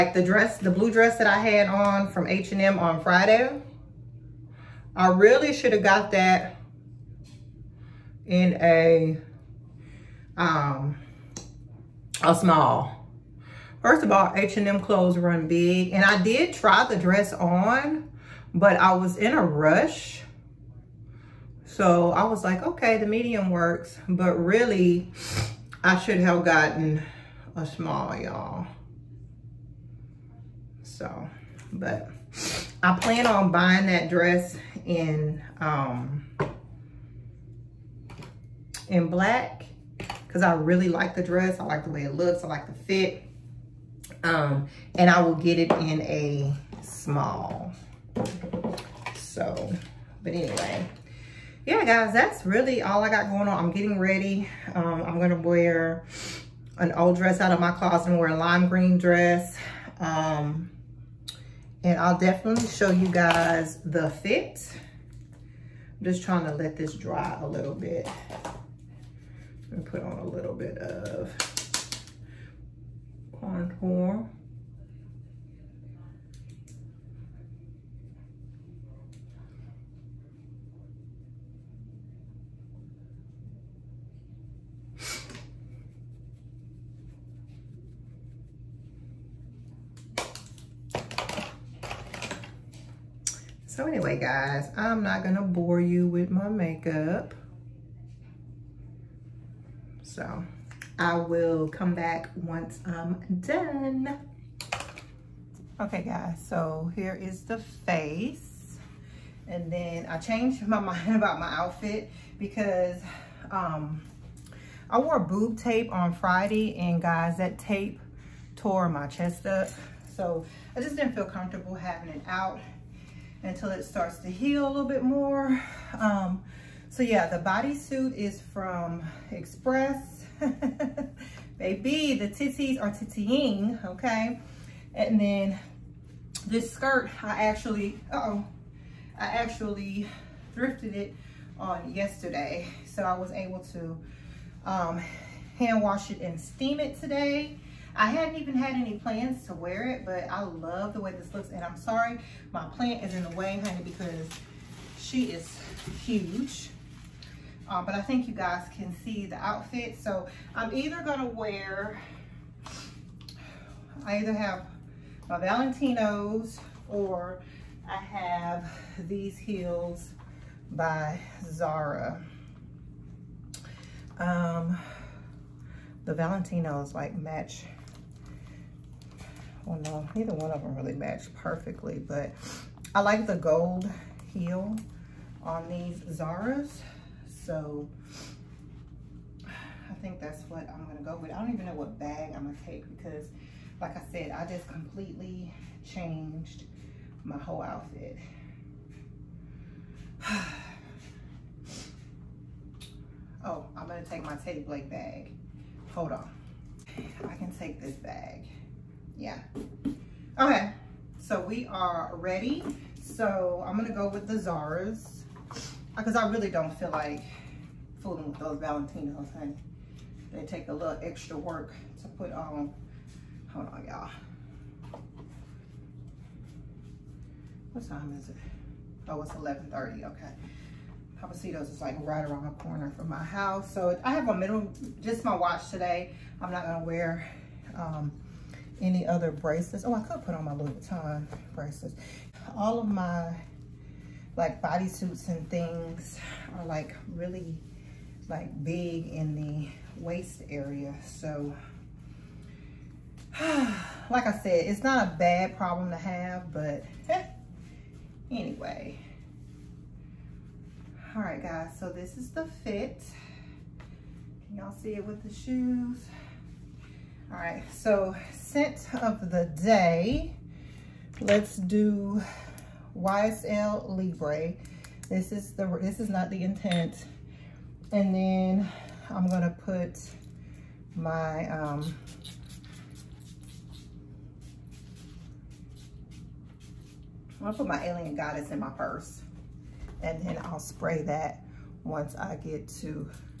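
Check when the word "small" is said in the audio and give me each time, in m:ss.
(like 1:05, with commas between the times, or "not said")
0:12, 0:27, 0:46.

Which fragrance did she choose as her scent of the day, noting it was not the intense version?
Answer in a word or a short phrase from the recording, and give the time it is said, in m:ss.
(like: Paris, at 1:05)
YSL Libre, at 4:32.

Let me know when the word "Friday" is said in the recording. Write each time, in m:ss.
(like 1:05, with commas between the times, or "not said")
0:03, 1:56.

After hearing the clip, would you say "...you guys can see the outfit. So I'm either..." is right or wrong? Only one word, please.
right.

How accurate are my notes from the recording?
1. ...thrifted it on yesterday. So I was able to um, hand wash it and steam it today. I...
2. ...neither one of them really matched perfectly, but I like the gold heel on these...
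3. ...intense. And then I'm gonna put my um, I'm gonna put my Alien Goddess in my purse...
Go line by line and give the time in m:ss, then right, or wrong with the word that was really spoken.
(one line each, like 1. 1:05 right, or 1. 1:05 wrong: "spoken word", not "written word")
1. 2:20 right
2. 3:00 right
3. 4:36 right.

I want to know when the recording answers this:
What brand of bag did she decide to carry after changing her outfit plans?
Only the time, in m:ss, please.
3:24.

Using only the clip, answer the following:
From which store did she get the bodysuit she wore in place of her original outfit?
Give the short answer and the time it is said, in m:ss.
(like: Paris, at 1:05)
Express, at 2:09.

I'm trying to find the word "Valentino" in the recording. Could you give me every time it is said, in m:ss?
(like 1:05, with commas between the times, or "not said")
2:45, 2:56, 3:38.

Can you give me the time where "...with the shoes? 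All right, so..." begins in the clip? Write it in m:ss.
4:25.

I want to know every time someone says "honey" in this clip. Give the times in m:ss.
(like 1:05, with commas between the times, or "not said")
2:33, 3:39.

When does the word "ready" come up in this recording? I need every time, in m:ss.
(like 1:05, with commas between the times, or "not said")
0:53, 3:32.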